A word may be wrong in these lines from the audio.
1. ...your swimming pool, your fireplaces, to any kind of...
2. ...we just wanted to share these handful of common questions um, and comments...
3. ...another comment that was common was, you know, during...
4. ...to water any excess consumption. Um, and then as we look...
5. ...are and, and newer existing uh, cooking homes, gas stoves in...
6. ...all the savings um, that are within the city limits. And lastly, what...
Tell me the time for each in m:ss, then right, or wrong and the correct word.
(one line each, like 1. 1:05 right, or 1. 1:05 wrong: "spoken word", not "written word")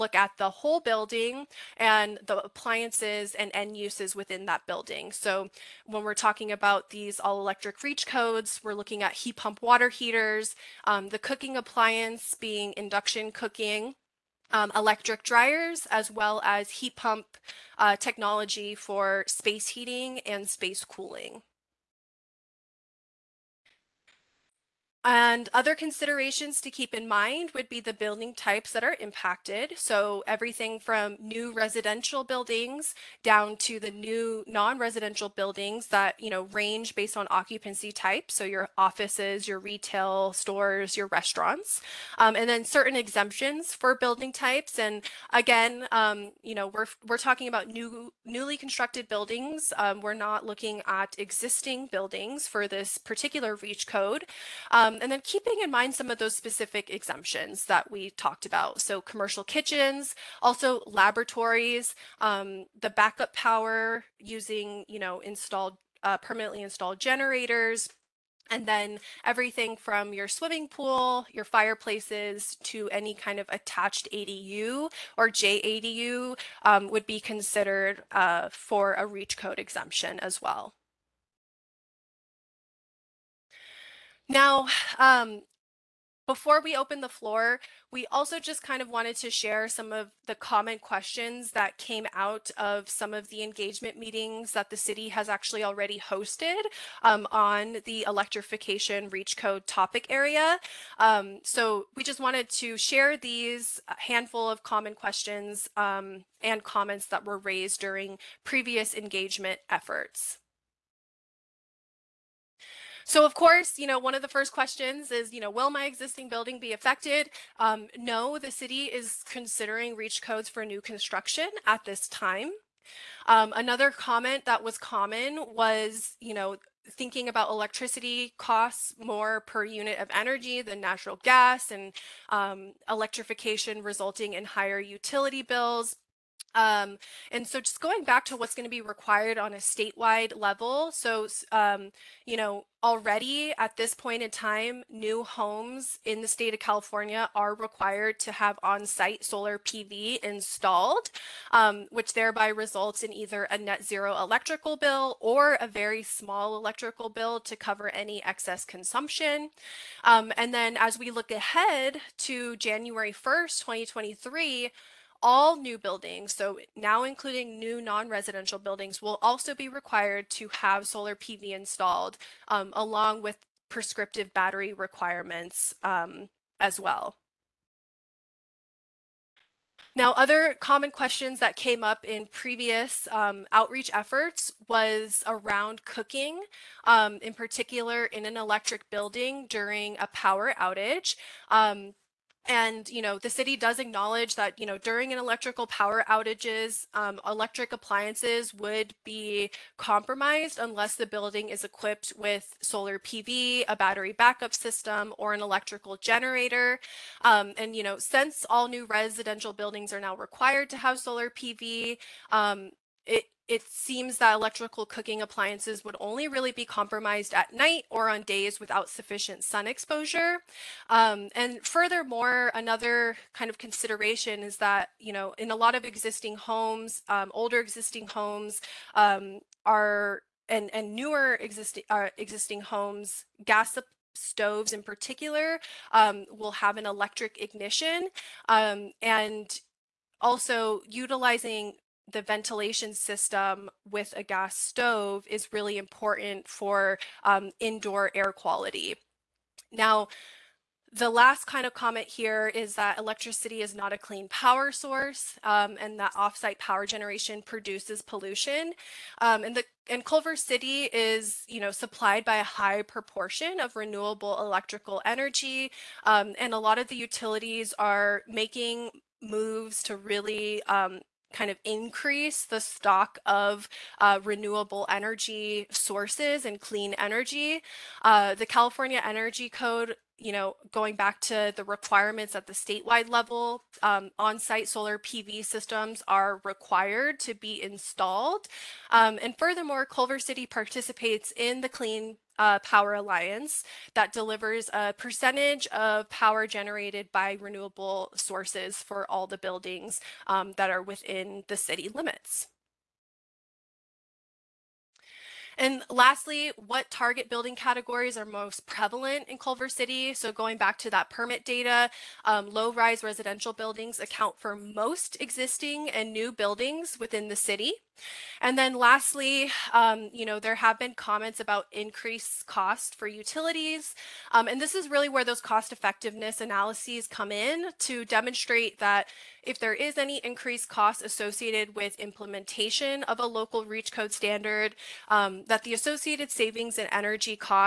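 1. 1:10 right
2. 1:41 right
3. 2:03 wrong: "thinking", not "during"
4. 2:37 wrong: "cover", not "water"
5. 3:49 wrong: "existing", not "cooking"
6. 4:59 wrong: "buildings", not "savings".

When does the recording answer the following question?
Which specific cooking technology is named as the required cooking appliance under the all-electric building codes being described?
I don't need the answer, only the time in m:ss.
0:12.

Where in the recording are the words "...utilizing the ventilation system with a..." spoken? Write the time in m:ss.
4:00.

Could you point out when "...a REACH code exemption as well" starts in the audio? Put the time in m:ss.
1:18.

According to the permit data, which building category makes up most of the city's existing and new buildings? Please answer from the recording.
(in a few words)
Low-rise residential buildings.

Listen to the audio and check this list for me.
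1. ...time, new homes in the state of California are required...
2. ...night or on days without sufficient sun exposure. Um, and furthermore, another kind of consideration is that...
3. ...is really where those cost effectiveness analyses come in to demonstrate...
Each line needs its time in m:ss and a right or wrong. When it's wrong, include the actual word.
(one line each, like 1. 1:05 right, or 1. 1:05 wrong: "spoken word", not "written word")
1. 2:24 right
2. 3:37 right
3. 5:24 right.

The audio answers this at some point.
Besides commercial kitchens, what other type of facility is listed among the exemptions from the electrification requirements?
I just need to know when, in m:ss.
1:00.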